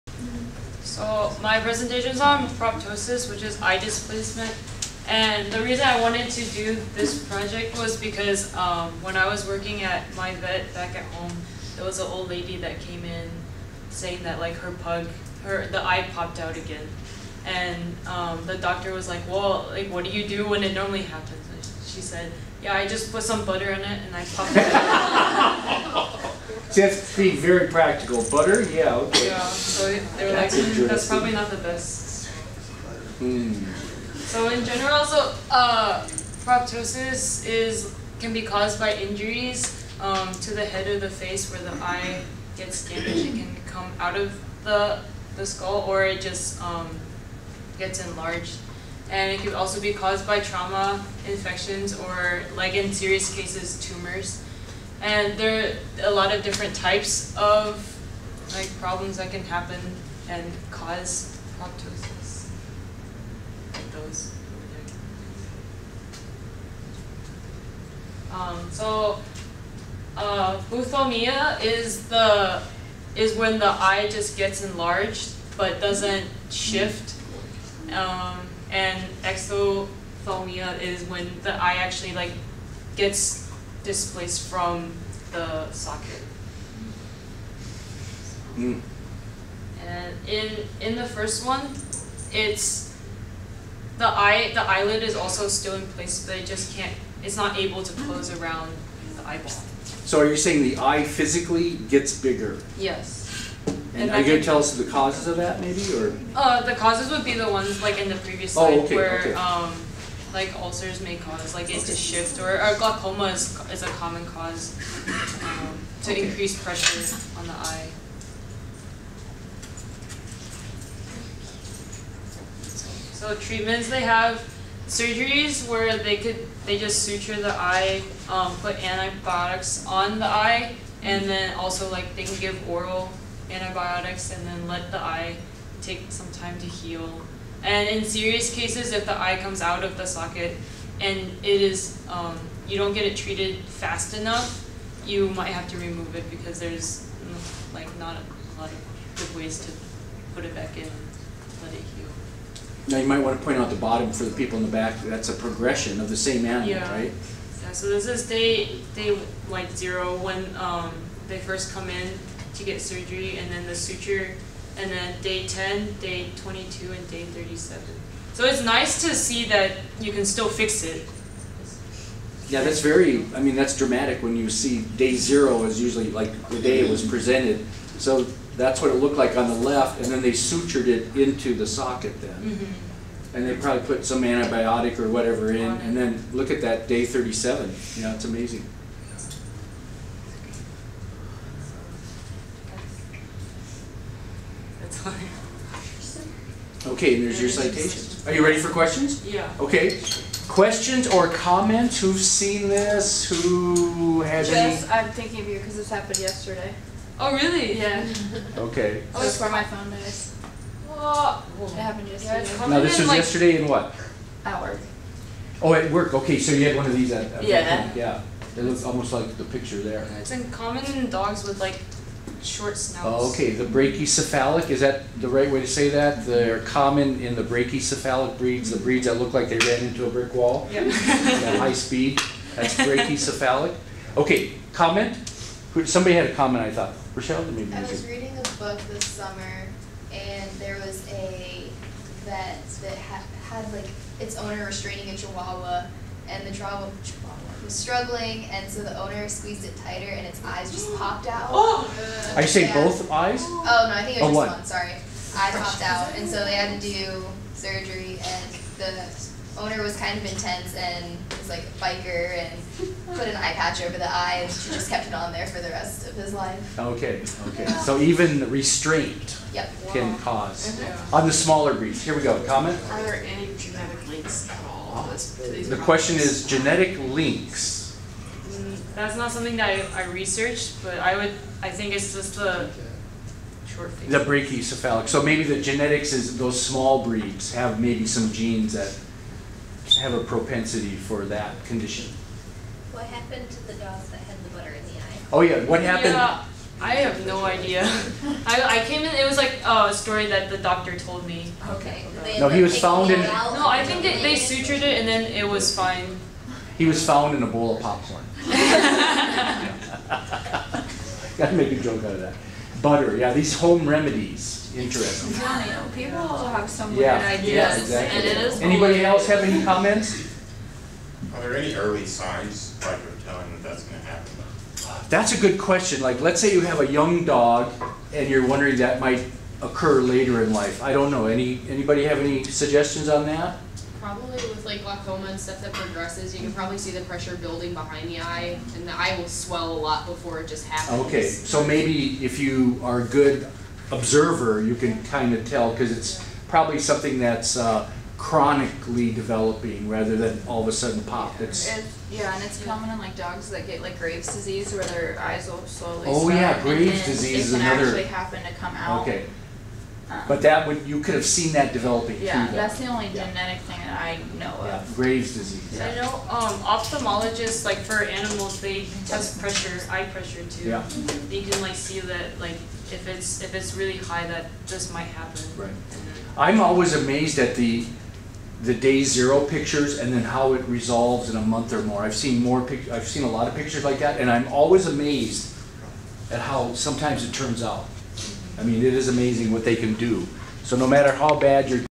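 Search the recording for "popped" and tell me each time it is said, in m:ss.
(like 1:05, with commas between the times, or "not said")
0:16, 0:24, 4:10, 4:15.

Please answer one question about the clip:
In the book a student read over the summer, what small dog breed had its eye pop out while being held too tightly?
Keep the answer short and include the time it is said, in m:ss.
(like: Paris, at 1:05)
chihuahua, at 4:05.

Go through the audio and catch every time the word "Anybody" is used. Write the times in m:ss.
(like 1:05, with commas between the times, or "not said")
5:18, 5:31.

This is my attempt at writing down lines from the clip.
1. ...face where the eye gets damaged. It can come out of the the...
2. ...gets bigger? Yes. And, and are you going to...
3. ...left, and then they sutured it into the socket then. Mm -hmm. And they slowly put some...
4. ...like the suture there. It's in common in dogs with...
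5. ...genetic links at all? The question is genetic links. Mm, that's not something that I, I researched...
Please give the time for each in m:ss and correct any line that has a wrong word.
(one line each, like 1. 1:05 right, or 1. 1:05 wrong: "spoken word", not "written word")
1. 0:41 right
2. 1:41 right
3. 2:59 wrong: "probably", not "slowly"
4. 3:39 wrong: "picture", not "suture"
5. 4:33 right.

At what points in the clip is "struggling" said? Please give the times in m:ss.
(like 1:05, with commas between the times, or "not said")
4:07.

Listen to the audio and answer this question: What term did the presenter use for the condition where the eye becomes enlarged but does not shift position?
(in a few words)
buphthalmia.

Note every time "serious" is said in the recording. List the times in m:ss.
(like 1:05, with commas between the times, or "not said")
0:52, 2:18.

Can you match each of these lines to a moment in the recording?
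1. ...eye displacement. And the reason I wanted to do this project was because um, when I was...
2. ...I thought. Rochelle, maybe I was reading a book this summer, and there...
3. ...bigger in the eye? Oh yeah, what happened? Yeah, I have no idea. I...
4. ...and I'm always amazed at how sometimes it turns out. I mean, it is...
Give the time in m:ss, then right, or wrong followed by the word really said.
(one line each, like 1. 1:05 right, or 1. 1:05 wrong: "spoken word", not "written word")
1. 0:03 right
2. 3:56 right
3. 4:54 wrong: "butter", not "bigger"
4. 6:24 right.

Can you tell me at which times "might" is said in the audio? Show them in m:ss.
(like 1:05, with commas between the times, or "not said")
2:25, 2:33, 5:28, 6:14.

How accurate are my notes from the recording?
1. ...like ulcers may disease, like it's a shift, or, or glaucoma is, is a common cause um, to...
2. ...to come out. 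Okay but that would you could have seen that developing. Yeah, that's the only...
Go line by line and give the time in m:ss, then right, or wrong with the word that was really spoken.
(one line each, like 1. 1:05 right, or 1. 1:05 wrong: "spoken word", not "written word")
1. 1:50 wrong: "cause", not "disease"
2. 5:58 right.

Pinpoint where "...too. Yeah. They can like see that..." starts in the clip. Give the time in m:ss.
6:10.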